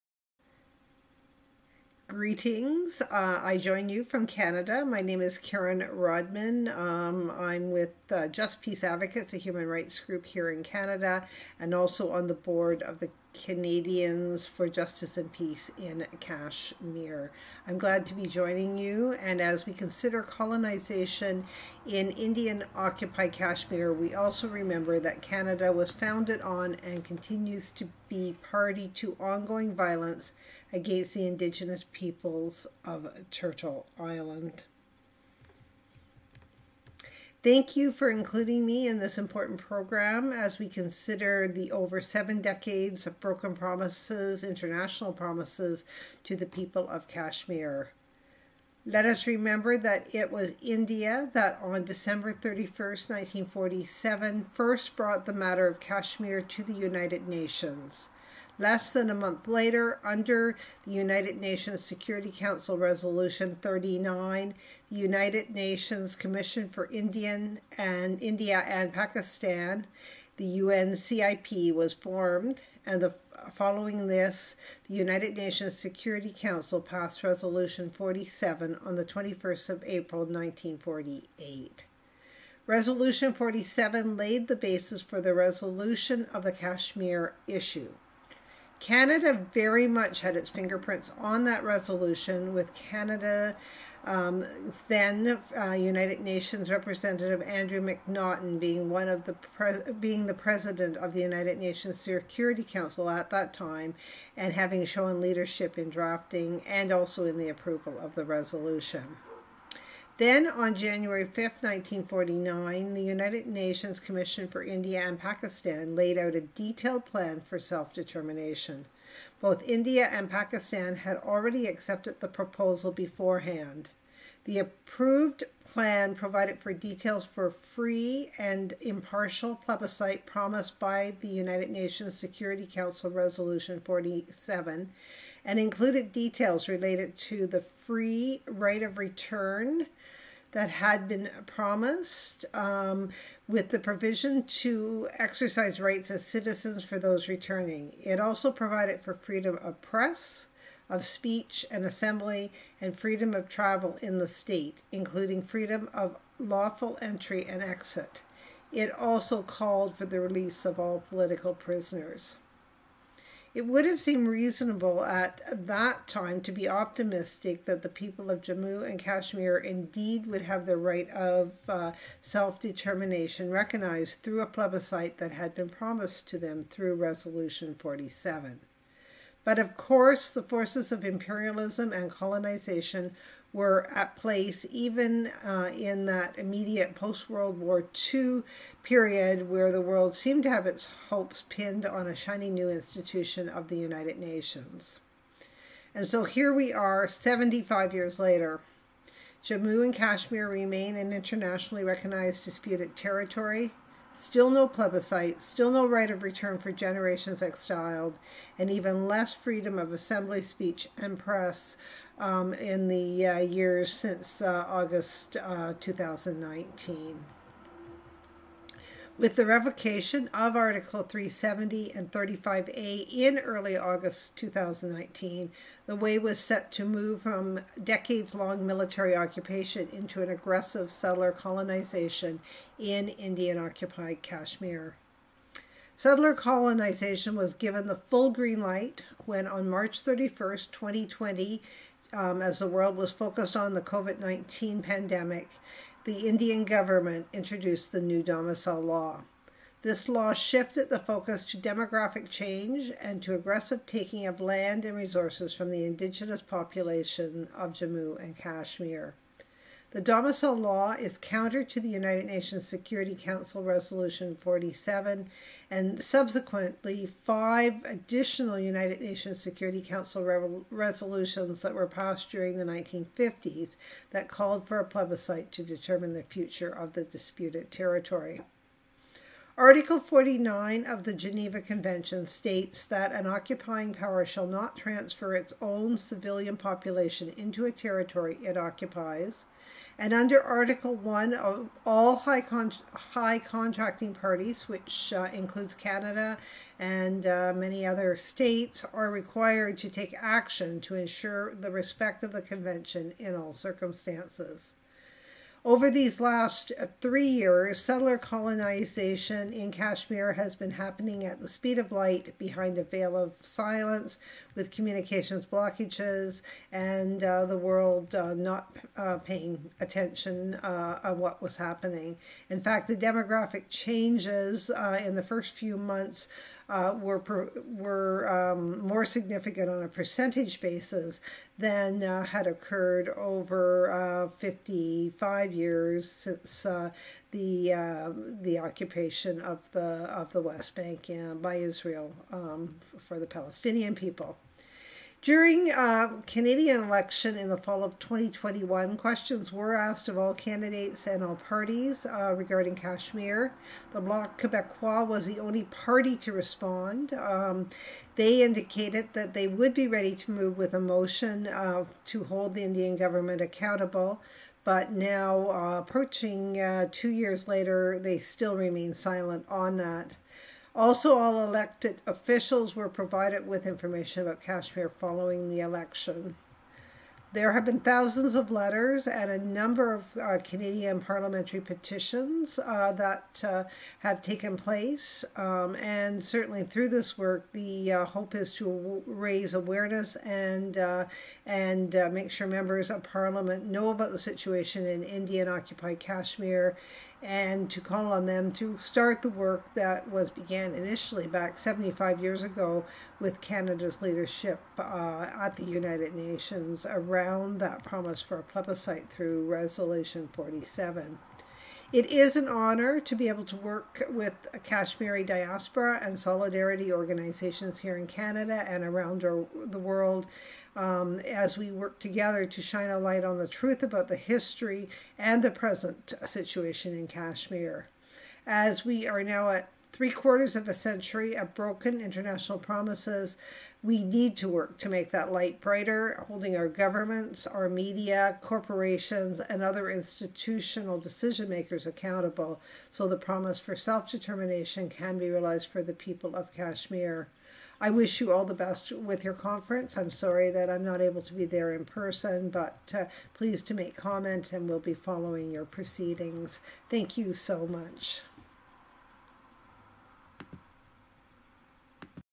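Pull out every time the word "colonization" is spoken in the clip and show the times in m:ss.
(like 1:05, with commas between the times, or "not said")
0:20, 3:02, 3:51, 3:56, 5:08.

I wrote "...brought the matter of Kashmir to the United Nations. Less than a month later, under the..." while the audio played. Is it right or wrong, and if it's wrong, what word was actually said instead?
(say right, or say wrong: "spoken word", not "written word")
right.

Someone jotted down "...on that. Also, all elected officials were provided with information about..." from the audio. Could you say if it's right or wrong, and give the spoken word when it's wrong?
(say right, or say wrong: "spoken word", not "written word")
right.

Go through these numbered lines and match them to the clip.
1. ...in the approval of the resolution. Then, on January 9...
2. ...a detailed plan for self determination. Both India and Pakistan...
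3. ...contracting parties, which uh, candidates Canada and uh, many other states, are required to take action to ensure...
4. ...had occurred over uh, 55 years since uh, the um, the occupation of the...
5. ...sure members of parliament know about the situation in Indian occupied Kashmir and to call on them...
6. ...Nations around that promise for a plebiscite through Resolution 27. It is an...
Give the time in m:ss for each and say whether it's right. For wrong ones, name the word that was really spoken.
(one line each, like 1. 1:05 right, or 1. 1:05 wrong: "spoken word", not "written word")
1. 1:47 wrong: "5", not "9"
2. 1:56 right
3. 4:53 wrong: "includes", not "candidates"
4. 5:32 right
5. 6:32 right
6. 6:46 wrong: "47", not "27".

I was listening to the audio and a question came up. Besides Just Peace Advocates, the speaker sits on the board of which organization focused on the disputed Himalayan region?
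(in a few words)
Canadians for Justice and Peace in Kashmir.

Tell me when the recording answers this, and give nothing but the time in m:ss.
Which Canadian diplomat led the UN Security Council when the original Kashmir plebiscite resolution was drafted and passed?
1:37.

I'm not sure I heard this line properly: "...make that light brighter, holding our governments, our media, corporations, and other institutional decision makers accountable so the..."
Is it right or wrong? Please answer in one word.
right.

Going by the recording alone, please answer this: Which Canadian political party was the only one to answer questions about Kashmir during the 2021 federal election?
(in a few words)
Bloc Quebecois.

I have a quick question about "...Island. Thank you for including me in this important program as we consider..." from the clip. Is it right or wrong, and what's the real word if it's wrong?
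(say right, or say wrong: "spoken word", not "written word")
right.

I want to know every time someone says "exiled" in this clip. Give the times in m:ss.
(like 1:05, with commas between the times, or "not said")
3:27.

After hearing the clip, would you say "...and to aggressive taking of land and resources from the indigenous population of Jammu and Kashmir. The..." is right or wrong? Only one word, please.
right.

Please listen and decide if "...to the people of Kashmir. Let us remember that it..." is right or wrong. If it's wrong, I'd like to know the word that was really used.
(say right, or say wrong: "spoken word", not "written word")
right.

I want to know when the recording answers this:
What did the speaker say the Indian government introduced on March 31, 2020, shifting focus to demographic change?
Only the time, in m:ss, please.
4:08.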